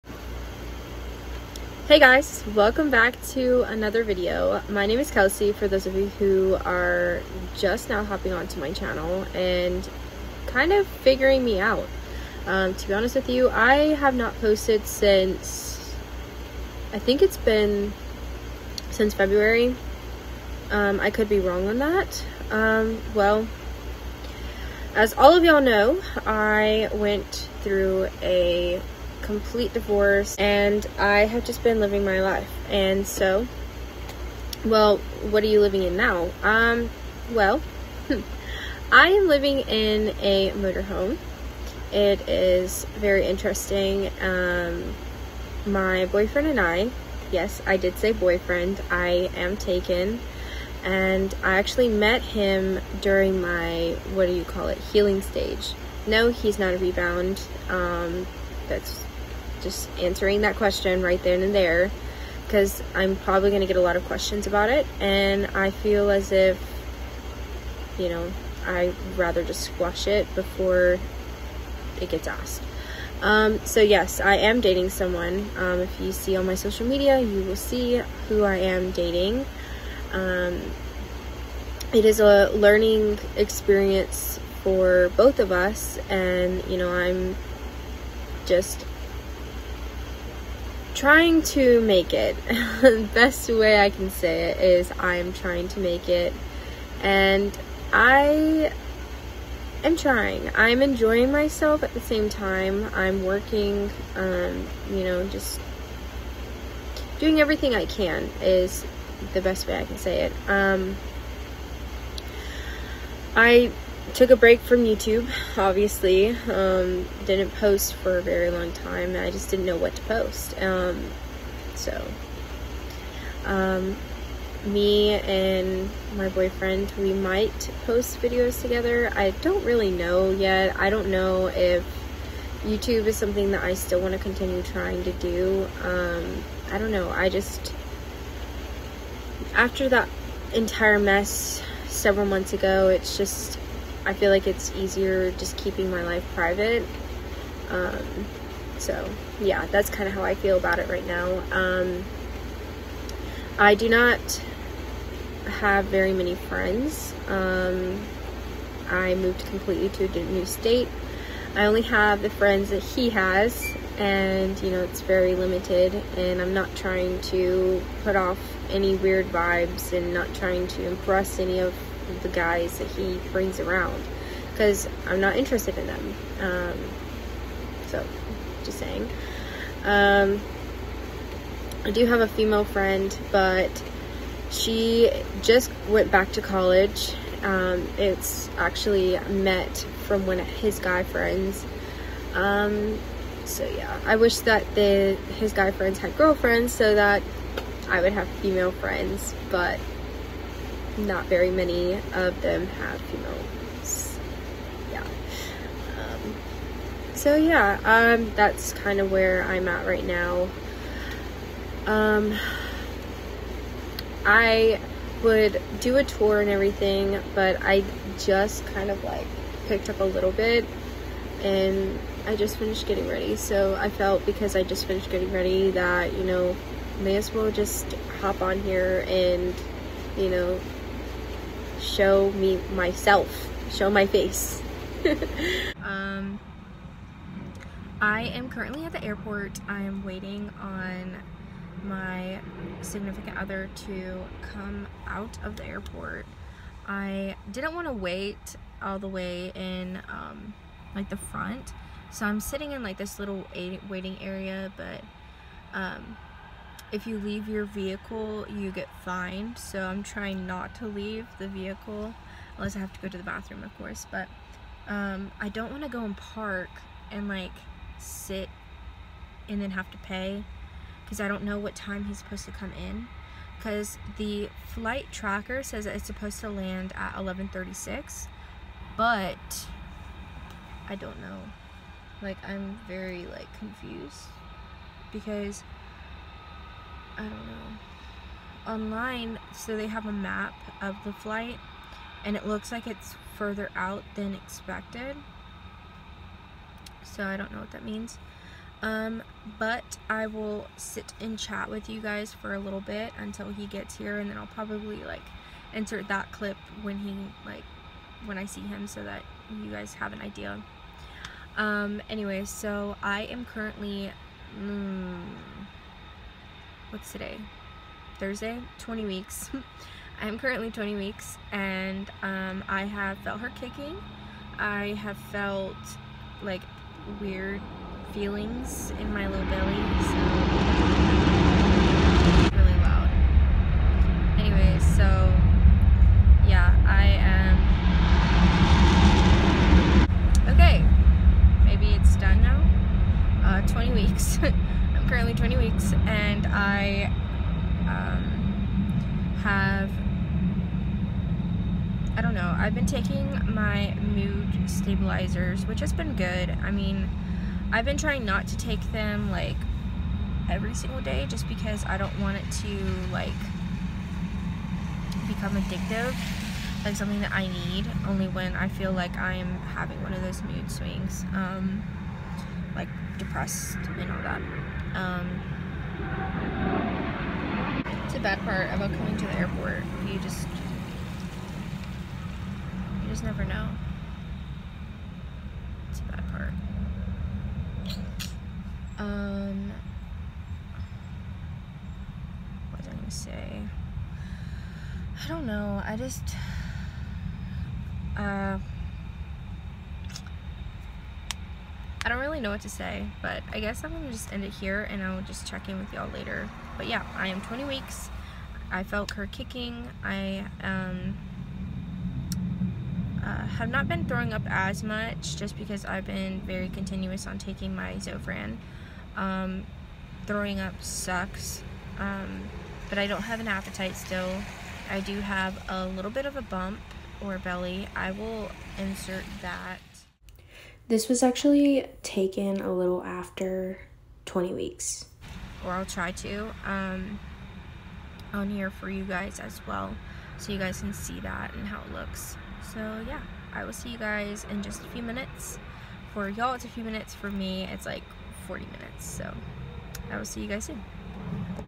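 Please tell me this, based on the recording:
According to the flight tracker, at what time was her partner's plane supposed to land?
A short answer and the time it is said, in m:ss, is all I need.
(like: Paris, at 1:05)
11:36, at 4:37.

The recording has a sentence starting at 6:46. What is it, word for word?
But yeah, I am 20 weeks.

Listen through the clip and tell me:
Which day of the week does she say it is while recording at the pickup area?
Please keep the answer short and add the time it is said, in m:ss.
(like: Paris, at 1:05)
Thursday, at 5:18.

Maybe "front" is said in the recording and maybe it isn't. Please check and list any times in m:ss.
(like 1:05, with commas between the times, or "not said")
4:11.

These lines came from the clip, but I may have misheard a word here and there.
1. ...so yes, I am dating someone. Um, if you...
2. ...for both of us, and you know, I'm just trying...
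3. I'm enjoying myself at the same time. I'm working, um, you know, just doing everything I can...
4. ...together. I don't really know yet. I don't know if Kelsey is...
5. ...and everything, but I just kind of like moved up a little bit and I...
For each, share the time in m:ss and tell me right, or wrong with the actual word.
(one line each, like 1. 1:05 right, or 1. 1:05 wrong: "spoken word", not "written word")
1. 1:13 right
2. 1:24 right
3. 1:40 right
4. 2:08 wrong: "YouTube", not "Kelsey"
5. 3:36 wrong: "picked", not "moved".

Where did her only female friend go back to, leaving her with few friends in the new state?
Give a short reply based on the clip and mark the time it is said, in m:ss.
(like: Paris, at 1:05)
College, at 3:06.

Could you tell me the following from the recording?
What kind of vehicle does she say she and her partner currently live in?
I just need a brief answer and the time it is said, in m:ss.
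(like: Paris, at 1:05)
A motorhome, at 0:40.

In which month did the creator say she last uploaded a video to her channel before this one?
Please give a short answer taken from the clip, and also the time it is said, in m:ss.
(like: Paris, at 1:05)
February, at 0:19.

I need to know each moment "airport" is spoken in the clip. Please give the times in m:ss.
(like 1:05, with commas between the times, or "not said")
3:59, 4:05, 6:19.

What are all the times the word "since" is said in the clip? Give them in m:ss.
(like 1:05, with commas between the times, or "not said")
0:14, 0:18.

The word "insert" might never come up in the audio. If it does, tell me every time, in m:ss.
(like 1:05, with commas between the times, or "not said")
5:05, 7:08.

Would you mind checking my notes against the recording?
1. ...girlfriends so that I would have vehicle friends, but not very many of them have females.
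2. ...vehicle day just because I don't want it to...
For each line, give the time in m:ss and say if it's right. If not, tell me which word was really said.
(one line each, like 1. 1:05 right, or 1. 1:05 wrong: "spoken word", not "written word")
1. 3:16 wrong: "female", not "vehicle"
2. 6:00 wrong: "single", not "vehicle".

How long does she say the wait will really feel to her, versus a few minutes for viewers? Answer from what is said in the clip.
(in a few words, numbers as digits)
40 minutes.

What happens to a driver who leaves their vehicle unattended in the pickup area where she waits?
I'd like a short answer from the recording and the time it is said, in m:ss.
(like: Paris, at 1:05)
You get fined, at 4:19.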